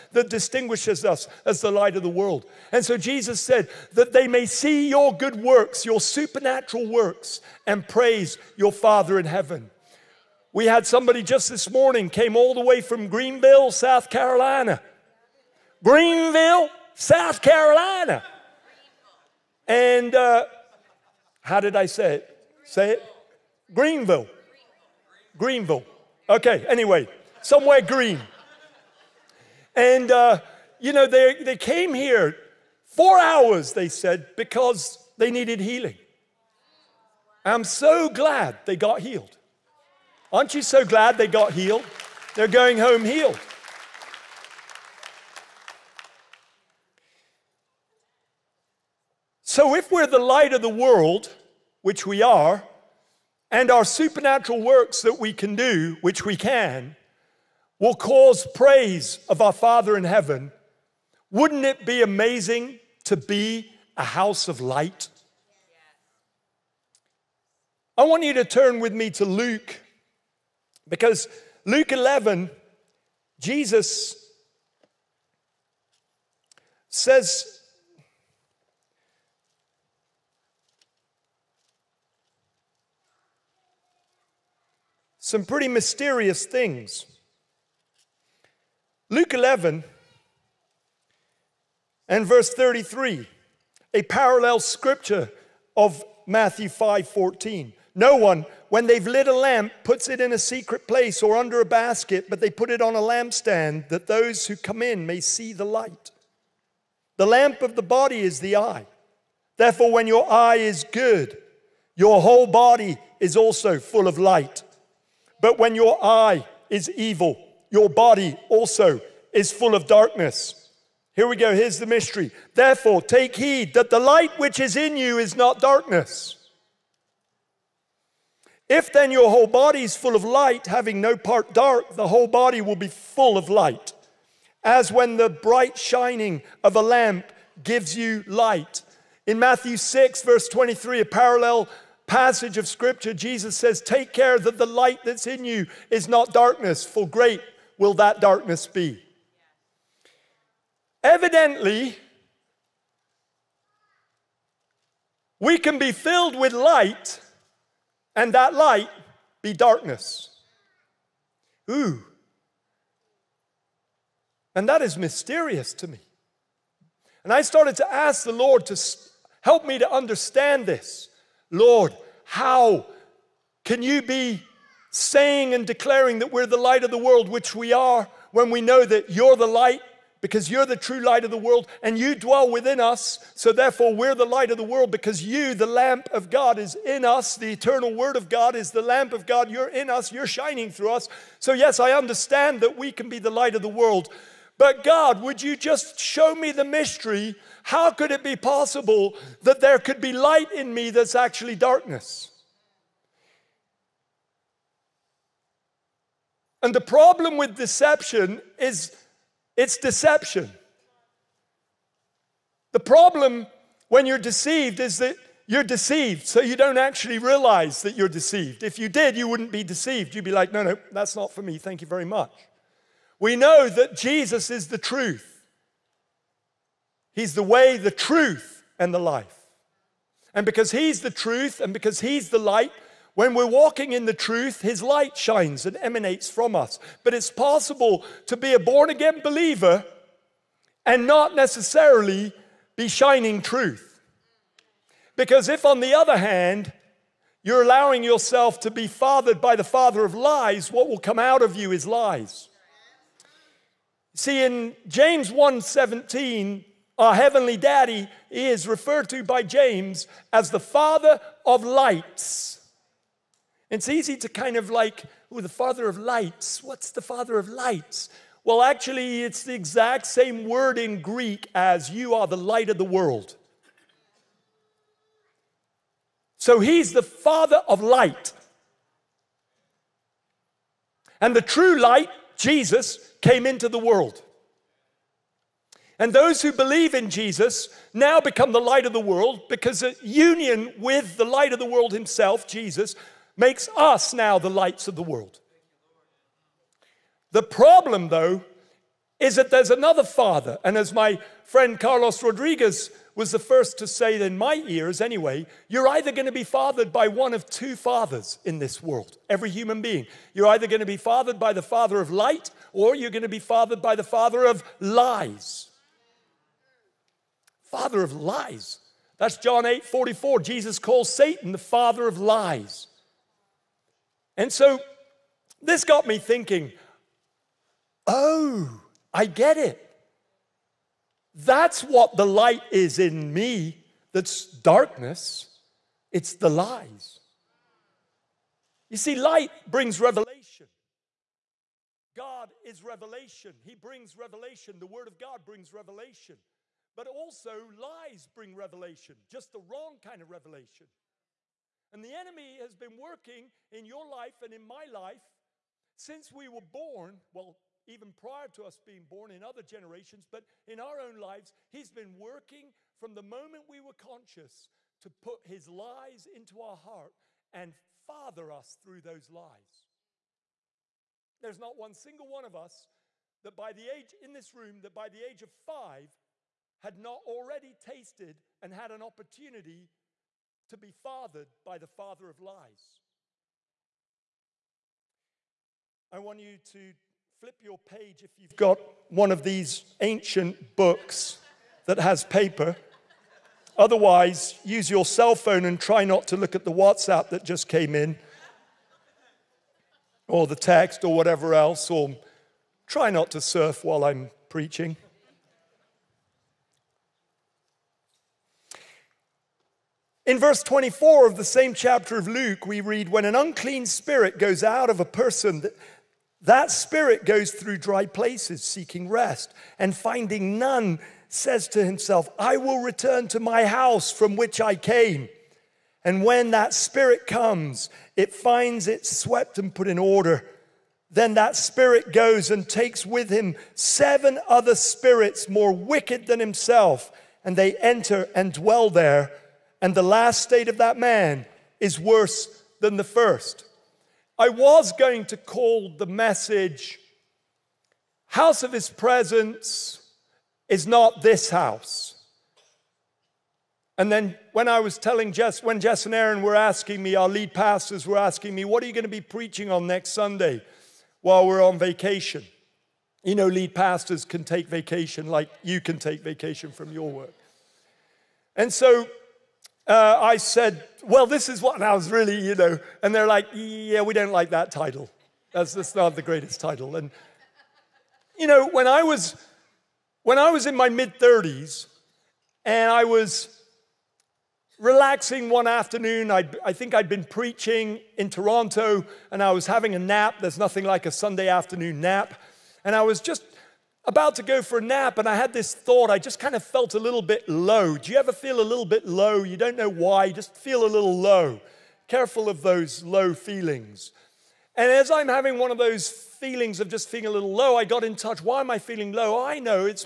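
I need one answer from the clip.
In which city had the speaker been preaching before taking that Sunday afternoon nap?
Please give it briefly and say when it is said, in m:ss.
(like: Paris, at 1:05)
Toronto, at 8:08.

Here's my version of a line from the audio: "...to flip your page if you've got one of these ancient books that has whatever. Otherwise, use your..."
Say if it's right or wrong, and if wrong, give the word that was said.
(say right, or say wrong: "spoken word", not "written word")
wrong: "paper", not "whatever".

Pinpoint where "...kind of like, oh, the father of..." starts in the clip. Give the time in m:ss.
4:24.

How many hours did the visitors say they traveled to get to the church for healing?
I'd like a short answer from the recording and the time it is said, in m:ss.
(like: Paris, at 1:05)
4, at 0:32.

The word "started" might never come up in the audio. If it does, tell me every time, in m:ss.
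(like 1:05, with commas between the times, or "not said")
2:47.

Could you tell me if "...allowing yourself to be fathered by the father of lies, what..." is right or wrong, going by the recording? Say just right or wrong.
right.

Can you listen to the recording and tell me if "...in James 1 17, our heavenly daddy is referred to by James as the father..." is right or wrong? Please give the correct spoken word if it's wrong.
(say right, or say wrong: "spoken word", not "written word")
right.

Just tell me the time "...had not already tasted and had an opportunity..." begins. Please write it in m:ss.
6:16.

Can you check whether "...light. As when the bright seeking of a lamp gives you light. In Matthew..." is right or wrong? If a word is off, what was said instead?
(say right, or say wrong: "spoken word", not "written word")
wrong: "shining", not "seeking".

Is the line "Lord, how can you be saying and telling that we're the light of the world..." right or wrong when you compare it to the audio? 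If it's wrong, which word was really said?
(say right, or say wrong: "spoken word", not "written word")
wrong: "declaring", not "telling".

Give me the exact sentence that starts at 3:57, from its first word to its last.
But it's possible to be a born again believer and not necessarily be shining truth.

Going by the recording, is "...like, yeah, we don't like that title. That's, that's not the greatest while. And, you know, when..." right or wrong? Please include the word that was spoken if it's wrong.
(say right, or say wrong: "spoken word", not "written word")
wrong: "title", not "while".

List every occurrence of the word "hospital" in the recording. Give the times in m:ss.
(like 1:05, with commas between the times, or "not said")
not said.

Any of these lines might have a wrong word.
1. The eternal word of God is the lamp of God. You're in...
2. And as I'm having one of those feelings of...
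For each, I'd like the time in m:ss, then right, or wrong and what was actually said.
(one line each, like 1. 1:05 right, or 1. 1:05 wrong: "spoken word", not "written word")
1. 3:07 right
2. 8:24 right.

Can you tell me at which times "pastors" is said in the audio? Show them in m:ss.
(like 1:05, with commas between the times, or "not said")
7:37, 7:43.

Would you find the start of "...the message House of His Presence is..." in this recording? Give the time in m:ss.
7:25.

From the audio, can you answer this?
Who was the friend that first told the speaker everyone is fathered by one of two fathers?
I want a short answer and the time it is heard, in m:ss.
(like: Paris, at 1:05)
Carlos Rodriguez, at 5:01.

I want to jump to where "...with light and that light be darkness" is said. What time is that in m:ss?
2:36.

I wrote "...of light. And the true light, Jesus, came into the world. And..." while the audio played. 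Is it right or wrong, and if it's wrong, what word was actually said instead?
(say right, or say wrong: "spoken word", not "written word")
right.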